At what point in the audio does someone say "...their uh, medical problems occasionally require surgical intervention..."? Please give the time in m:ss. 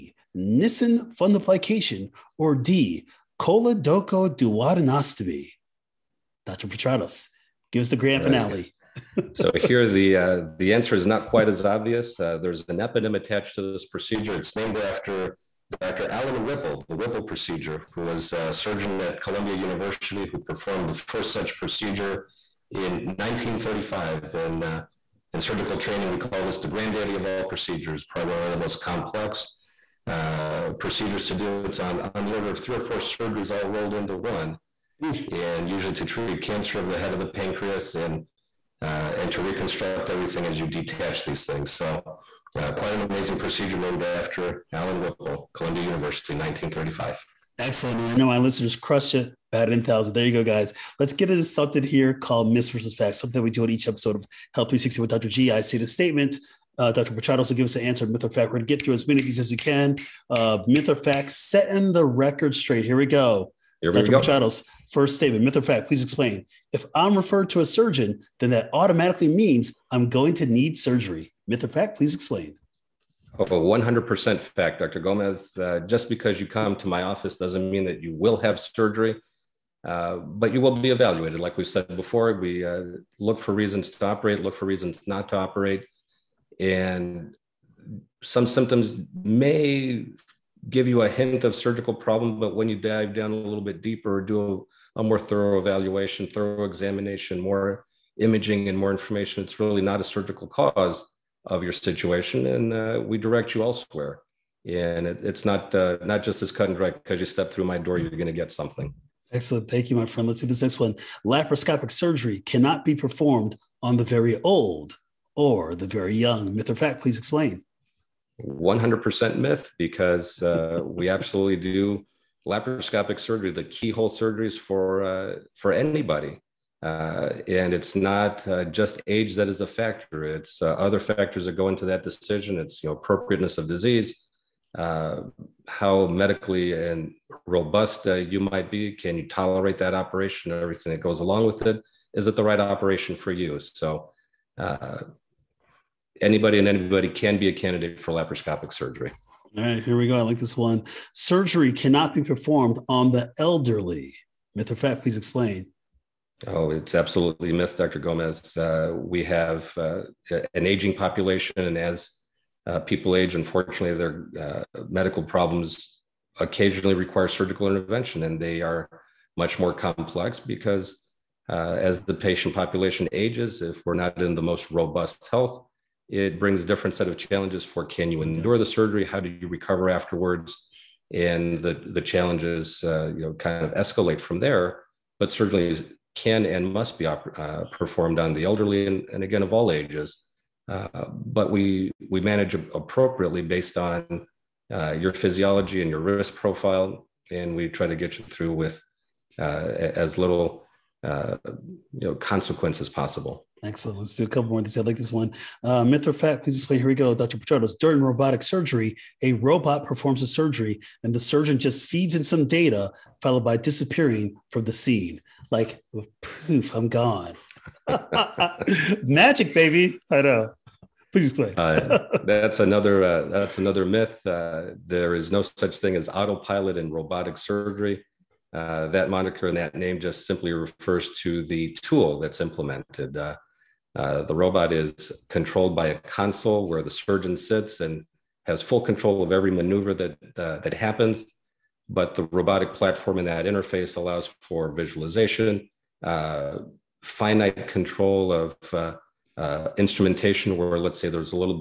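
2:43.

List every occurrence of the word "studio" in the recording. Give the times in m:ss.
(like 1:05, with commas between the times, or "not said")
not said.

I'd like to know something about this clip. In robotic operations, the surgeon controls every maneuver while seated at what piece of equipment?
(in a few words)
A console.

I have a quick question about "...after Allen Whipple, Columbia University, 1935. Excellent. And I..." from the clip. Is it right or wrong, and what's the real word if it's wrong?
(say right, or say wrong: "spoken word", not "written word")
right.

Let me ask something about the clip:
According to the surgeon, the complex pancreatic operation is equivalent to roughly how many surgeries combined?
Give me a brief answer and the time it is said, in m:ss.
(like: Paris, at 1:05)
3 or 4, at 0:32.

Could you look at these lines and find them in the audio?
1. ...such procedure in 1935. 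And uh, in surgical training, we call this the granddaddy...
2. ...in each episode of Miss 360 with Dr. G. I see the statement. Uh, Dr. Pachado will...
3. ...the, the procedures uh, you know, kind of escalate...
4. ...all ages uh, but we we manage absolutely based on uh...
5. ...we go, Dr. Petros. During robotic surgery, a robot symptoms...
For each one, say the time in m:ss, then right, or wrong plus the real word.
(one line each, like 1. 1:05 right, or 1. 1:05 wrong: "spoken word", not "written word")
1. 0:21 right
2. 0:53 wrong: "Health", not "Miss"
3. 3:01 wrong: "challenges", not "procedures"
4. 3:09 wrong: "appropriately", not "absolutely"
5. 3:26 wrong: "performs", not "symptoms".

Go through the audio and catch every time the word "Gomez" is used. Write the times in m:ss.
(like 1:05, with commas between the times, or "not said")
1:14, 2:37.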